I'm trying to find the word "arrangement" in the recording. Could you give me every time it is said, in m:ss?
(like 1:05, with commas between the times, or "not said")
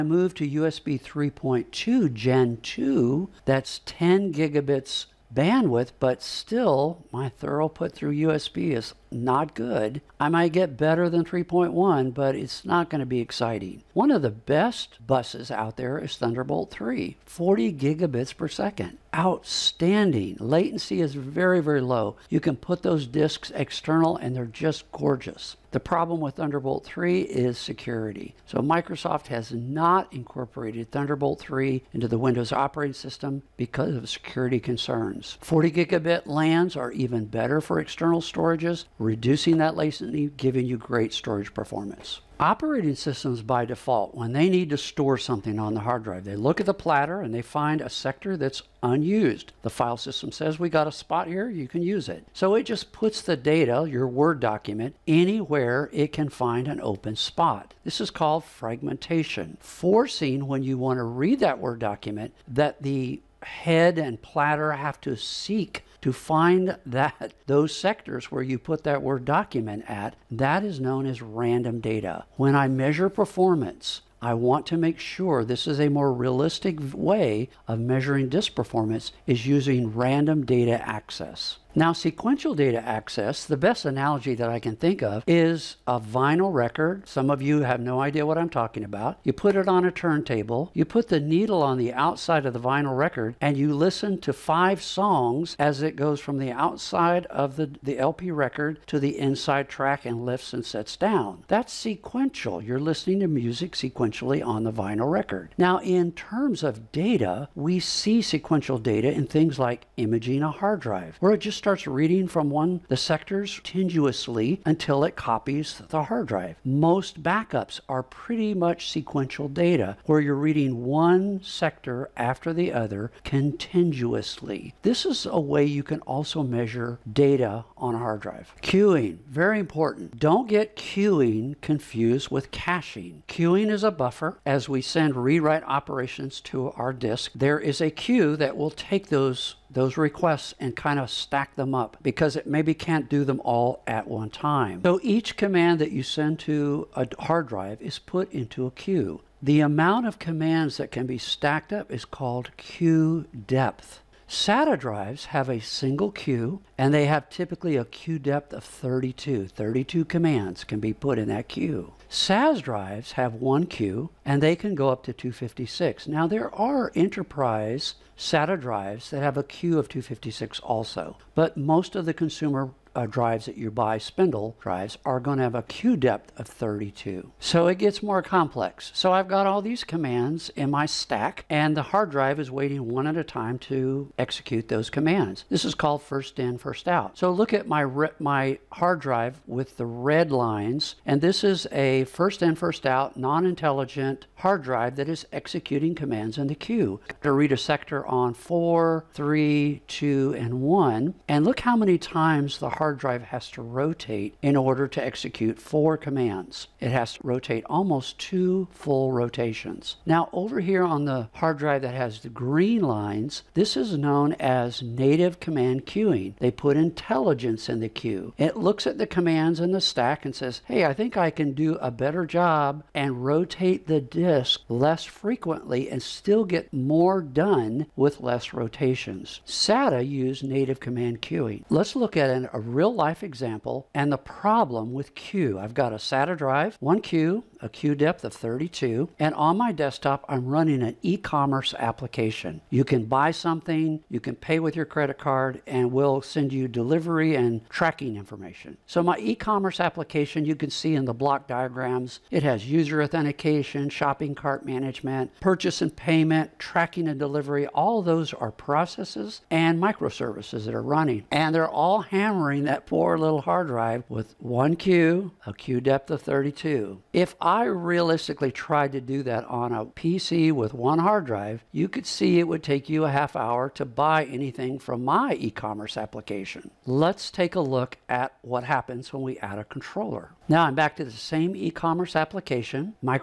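not said.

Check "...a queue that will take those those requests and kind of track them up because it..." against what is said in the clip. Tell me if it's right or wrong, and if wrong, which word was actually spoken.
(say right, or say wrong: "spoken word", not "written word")
wrong: "stack", not "track".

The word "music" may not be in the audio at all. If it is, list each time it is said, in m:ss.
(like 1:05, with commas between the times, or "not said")
1:43.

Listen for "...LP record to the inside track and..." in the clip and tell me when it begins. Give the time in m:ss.
1:37.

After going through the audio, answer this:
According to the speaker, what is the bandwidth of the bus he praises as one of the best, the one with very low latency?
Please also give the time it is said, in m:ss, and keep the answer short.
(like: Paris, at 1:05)
40 gigabits per second, at 0:17.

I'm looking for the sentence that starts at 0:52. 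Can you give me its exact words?
So it just puts the data, your Word document, anywhere it can find an open spot.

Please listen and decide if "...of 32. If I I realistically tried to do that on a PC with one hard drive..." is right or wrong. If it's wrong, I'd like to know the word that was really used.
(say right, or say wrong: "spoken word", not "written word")
right.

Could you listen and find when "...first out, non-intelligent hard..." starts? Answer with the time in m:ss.
3:12.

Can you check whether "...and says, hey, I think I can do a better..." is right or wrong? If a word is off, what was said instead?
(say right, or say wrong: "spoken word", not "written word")
right.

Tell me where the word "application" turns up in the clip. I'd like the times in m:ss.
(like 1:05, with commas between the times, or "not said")
4:01, 4:09, 4:35, 4:42.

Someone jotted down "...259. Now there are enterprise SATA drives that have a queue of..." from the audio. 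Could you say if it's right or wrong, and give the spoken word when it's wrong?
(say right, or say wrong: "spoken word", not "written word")
wrong: "256", not "259".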